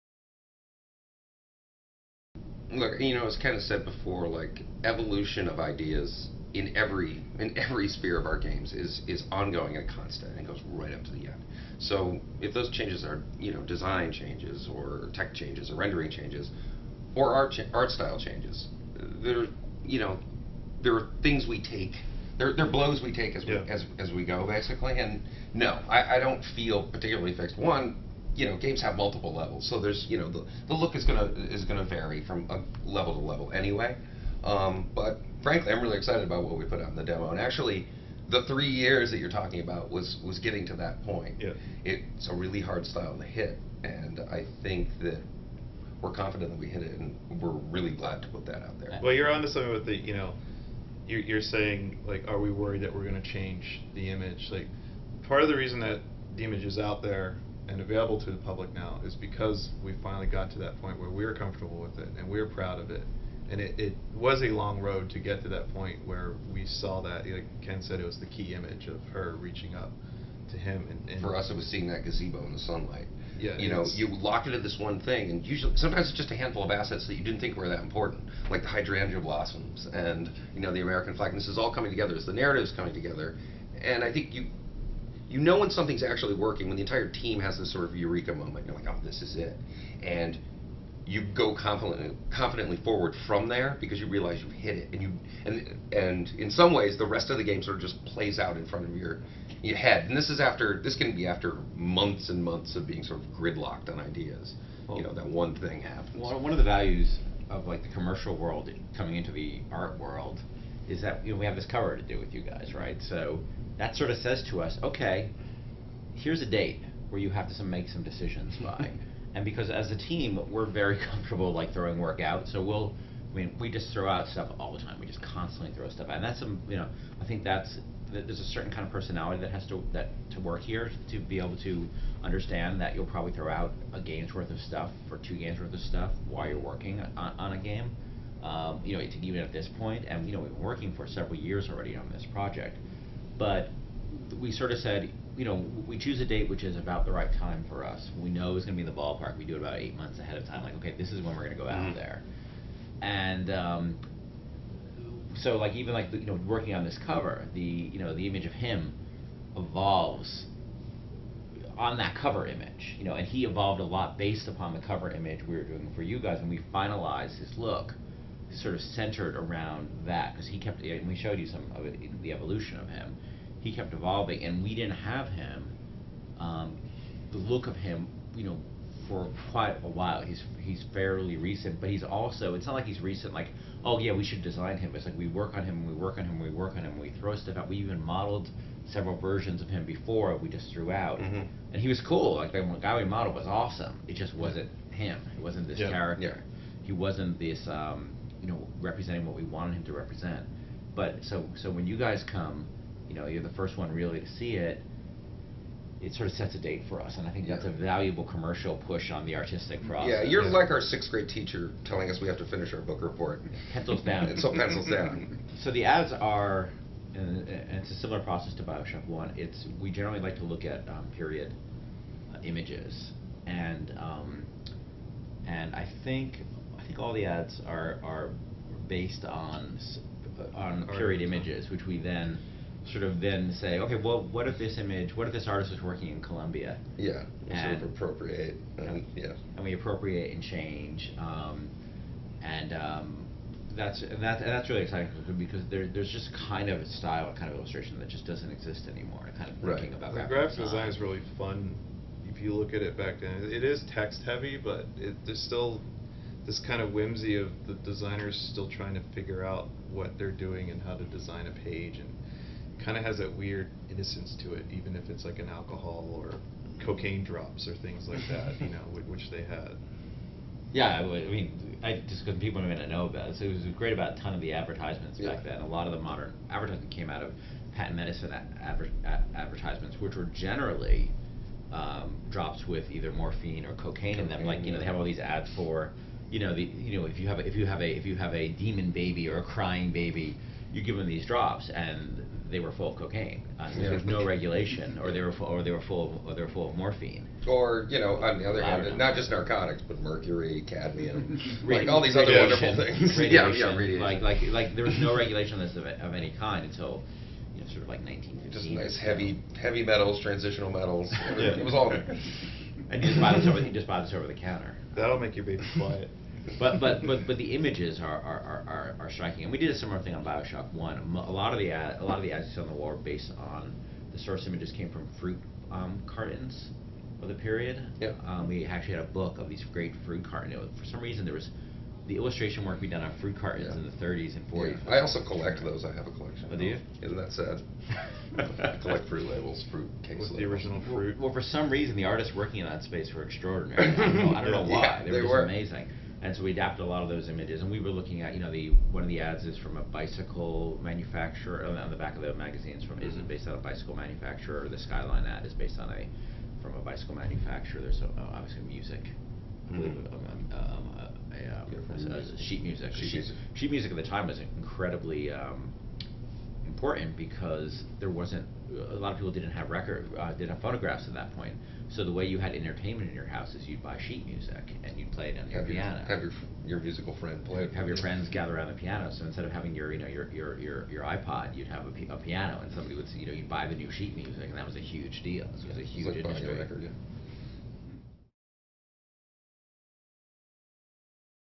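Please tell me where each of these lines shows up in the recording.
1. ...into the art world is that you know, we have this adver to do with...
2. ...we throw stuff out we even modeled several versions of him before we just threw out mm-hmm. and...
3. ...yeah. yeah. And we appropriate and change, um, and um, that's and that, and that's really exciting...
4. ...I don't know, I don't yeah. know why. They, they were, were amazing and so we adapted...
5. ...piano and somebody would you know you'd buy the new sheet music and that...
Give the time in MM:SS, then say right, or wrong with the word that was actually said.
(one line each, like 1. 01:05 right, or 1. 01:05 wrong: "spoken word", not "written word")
1. 01:49 wrong: "cover", not "adver"
2. 03:07 right
3. 03:59 right
4. 05:43 right
5. 06:22 right.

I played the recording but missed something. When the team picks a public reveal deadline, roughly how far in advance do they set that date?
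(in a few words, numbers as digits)
8 months.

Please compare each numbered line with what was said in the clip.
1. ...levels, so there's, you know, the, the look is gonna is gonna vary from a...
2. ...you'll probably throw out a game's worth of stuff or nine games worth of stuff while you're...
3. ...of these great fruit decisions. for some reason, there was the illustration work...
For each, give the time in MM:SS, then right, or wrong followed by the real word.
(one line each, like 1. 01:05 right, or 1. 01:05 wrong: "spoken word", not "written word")
1. 00:29 right
2. 02:12 wrong: "two", not "nine"
3. 05:29 wrong: "cartons", not "decisions".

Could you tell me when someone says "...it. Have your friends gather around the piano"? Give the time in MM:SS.
06:17.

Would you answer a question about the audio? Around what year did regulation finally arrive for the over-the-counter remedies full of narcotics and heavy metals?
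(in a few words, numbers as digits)
1915.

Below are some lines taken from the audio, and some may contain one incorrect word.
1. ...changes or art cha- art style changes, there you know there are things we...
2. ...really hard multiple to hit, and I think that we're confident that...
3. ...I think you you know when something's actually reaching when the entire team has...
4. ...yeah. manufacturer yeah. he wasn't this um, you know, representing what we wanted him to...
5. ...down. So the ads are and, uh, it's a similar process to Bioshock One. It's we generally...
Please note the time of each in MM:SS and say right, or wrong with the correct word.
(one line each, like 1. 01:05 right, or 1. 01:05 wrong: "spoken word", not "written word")
1. 00:16 right
2. 00:42 wrong: "style", not "multiple"
3. 01:24 wrong: "working", not "reaching"
4. 03:15 wrong: "character", not "manufacturer"
5. 03:34 right.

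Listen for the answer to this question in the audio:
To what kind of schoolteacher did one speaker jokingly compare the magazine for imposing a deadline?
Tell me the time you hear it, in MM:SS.
03:30.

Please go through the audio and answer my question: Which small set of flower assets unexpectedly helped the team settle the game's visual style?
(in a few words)
hydrangea blossoms.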